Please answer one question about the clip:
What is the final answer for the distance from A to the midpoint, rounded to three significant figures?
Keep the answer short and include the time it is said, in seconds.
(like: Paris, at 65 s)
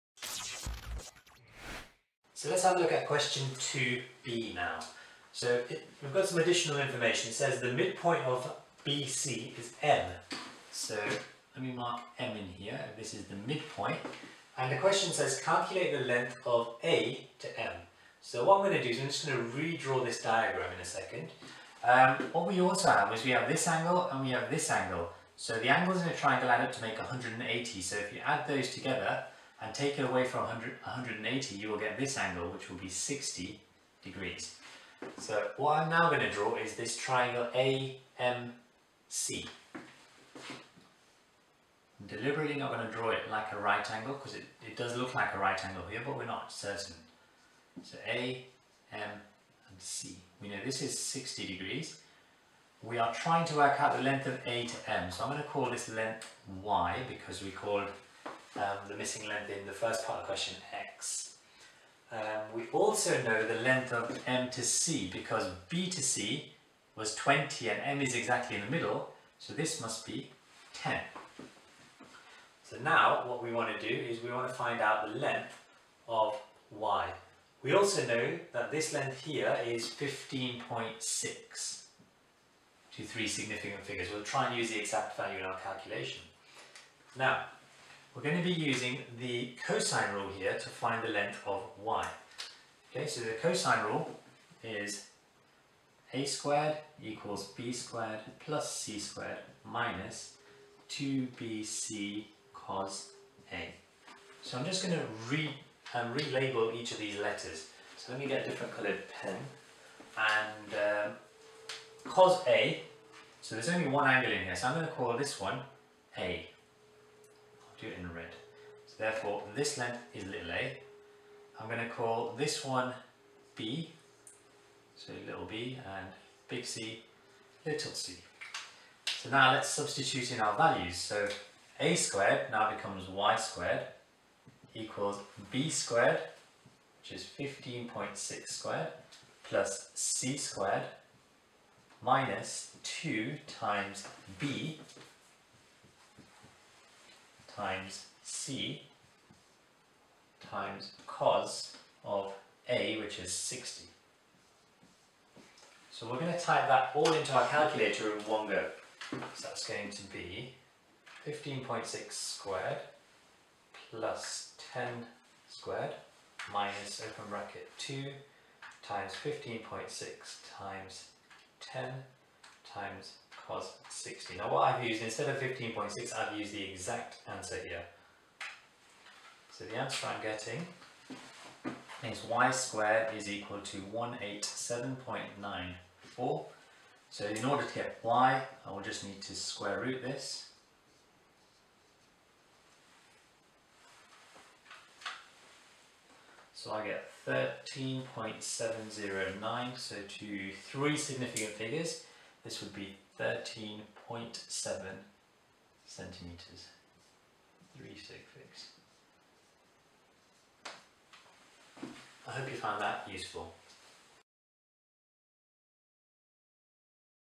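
13.7 centimeters, at 203 s.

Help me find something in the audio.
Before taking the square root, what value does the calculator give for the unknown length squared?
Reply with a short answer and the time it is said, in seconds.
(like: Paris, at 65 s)
187.94, at 183 s.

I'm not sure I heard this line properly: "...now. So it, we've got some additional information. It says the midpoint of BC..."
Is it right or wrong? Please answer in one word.
right.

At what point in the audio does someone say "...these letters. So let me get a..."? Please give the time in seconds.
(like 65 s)
106 s.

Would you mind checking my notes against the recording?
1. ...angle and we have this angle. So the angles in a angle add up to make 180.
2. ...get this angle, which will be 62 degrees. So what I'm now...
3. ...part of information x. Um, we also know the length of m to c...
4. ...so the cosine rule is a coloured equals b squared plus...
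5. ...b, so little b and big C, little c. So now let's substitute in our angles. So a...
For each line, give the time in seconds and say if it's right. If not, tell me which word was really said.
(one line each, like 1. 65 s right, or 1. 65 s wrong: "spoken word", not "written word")
1. 23 s wrong: "triangle", not "angle"
2. 31 s wrong: "60", not "62"
3. 60 s wrong: "question", not "information"
4. 93 s wrong: "squared", not "coloured"
5. 123 s wrong: "values", not "angles".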